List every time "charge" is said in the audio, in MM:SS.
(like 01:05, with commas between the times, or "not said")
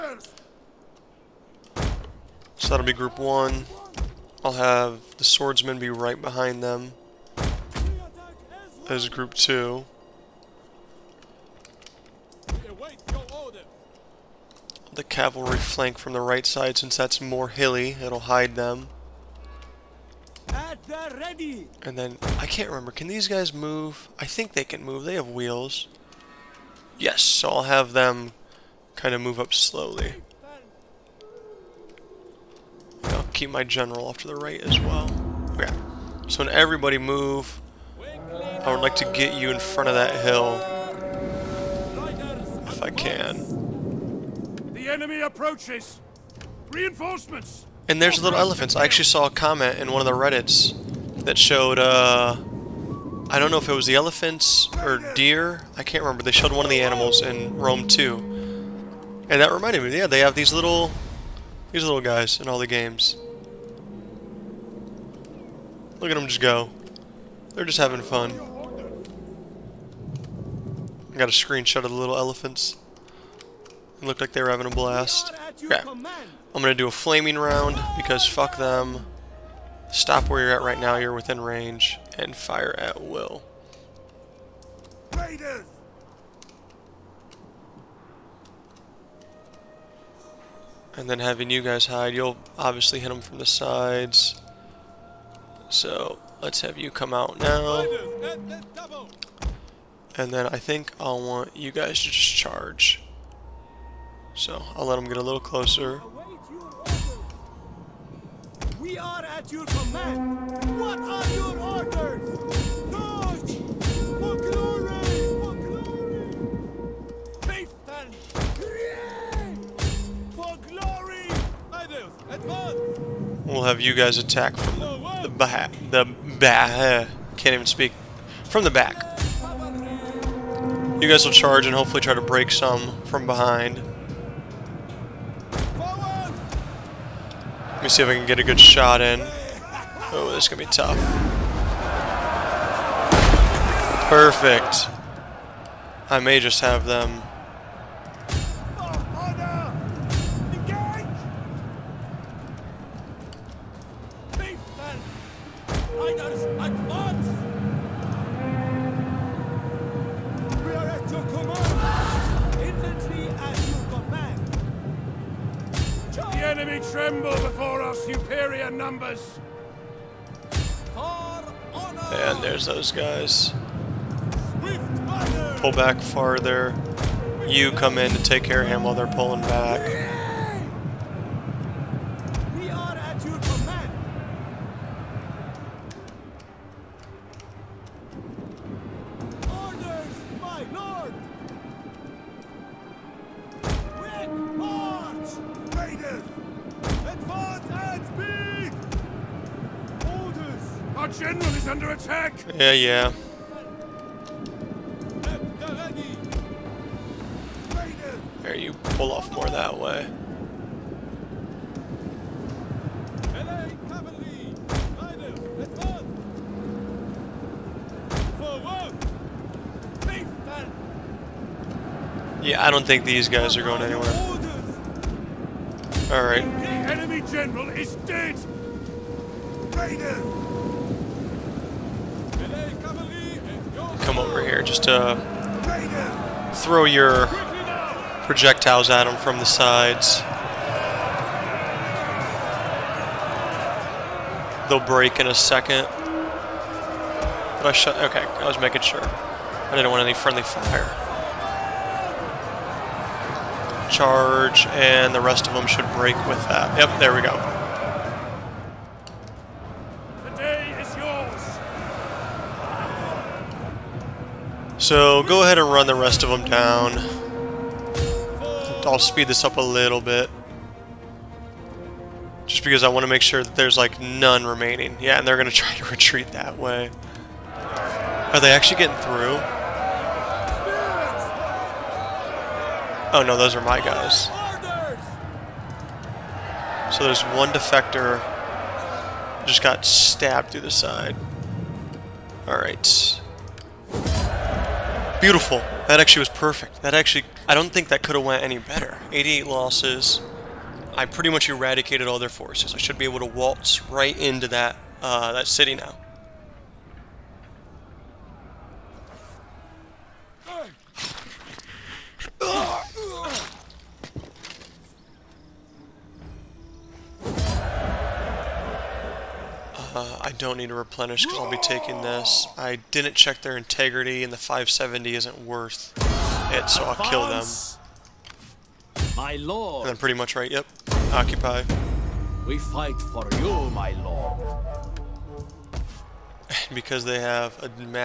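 01:42, 02:11, 04:13.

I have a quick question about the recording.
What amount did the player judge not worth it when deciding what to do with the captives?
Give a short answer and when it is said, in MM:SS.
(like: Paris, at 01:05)
570, at 05:24.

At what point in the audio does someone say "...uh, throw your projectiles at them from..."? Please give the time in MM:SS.
03:54.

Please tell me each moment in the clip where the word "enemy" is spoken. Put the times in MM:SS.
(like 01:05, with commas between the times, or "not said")
00:44, 03:46.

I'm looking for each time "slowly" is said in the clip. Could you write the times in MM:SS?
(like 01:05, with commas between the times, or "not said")
00:29.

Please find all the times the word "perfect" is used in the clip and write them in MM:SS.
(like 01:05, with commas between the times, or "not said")
02:24, 04:56.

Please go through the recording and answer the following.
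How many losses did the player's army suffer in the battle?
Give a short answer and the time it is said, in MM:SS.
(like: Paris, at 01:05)
88, at 04:59.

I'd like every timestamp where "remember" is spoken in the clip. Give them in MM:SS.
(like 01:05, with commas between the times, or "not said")
00:22, 00:56.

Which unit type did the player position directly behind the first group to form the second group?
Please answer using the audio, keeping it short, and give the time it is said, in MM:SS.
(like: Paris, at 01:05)
Swordsmen, at 00:05.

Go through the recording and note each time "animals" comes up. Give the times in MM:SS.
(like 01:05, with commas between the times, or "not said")
00:56.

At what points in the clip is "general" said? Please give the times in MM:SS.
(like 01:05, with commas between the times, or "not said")
00:33, 03:47.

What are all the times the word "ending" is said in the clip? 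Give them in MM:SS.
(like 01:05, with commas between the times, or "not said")
not said.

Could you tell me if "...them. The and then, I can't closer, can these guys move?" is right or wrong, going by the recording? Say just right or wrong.
wrong.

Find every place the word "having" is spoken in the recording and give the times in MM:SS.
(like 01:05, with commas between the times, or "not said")
01:07, 01:14, 01:31.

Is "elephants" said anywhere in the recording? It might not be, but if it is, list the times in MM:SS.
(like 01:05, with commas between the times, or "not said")
00:48, 00:53, 01:12.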